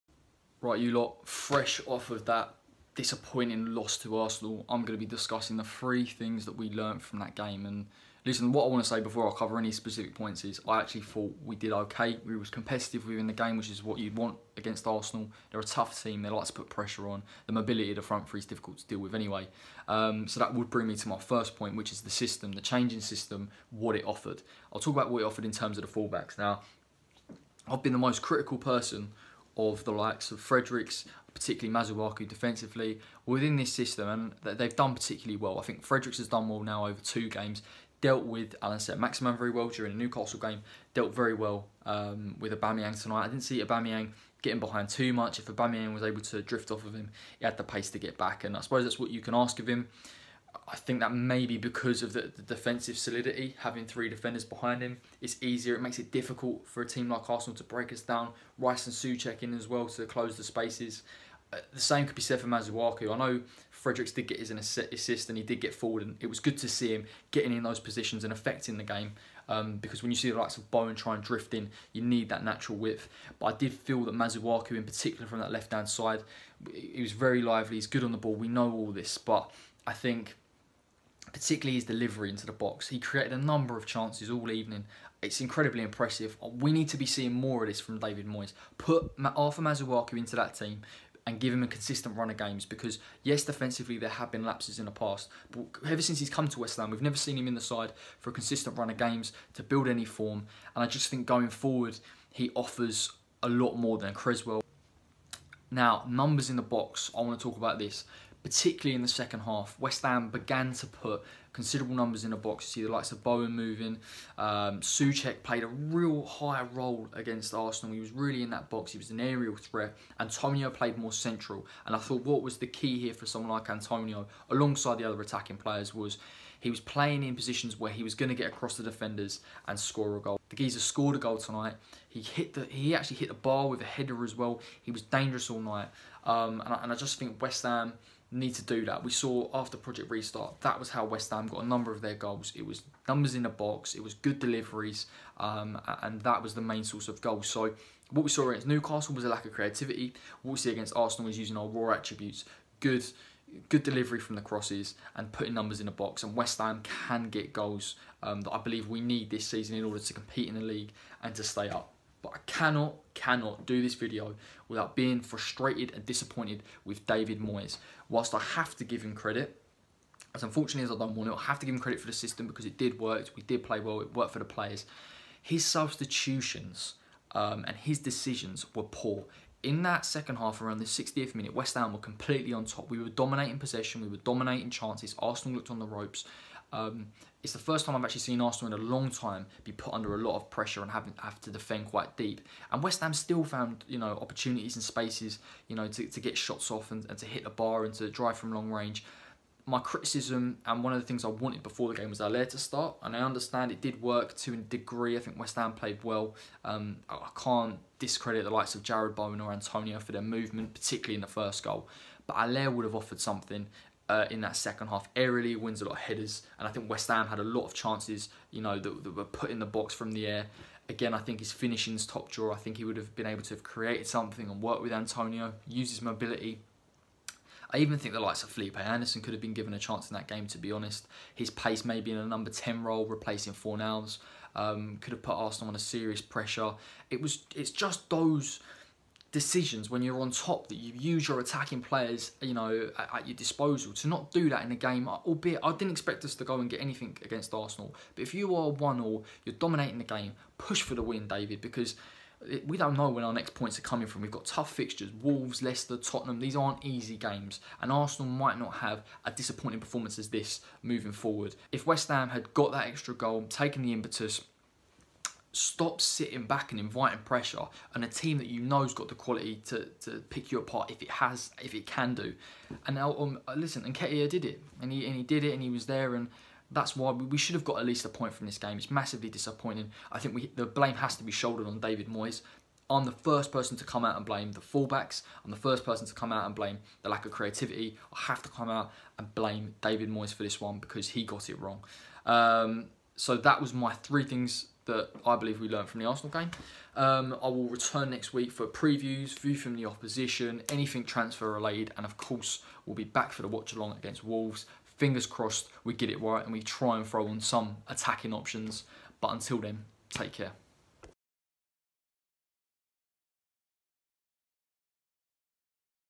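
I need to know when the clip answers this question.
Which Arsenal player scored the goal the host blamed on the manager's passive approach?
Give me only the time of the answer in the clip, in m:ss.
4:33.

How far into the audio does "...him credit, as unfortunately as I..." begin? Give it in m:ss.
2:49.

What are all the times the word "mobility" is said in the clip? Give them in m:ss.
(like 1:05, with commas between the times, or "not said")
0:17, 3:46.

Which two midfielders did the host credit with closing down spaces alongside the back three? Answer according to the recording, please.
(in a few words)
Rice and Soucek.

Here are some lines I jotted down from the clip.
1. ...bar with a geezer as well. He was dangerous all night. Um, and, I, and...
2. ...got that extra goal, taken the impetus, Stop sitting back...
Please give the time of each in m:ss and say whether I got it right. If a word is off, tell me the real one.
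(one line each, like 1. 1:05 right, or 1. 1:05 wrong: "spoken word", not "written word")
1. 2:13 wrong: "header", not "geezer"
2. 4:22 right.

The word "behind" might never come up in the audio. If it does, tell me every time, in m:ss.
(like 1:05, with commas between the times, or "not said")
0:44, 0:54.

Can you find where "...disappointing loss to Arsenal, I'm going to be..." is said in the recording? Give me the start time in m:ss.
0:02.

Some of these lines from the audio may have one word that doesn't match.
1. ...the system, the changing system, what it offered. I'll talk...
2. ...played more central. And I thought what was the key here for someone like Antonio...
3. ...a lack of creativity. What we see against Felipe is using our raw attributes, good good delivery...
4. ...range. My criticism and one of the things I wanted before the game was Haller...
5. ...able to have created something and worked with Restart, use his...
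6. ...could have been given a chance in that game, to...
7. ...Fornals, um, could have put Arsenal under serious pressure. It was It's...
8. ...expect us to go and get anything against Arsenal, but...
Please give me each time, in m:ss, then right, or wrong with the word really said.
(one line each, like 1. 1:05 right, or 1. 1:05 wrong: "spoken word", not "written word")
1. 0:22 right
2. 2:00 right
3. 2:29 wrong: "Arsenal", not "Felipe"
4. 3:18 right
5. 3:43 wrong: "Antonio", not "Restart"
6. 3:49 right
7. 3:53 right
8. 4:05 right.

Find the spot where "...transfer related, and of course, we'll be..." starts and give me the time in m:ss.
5:01.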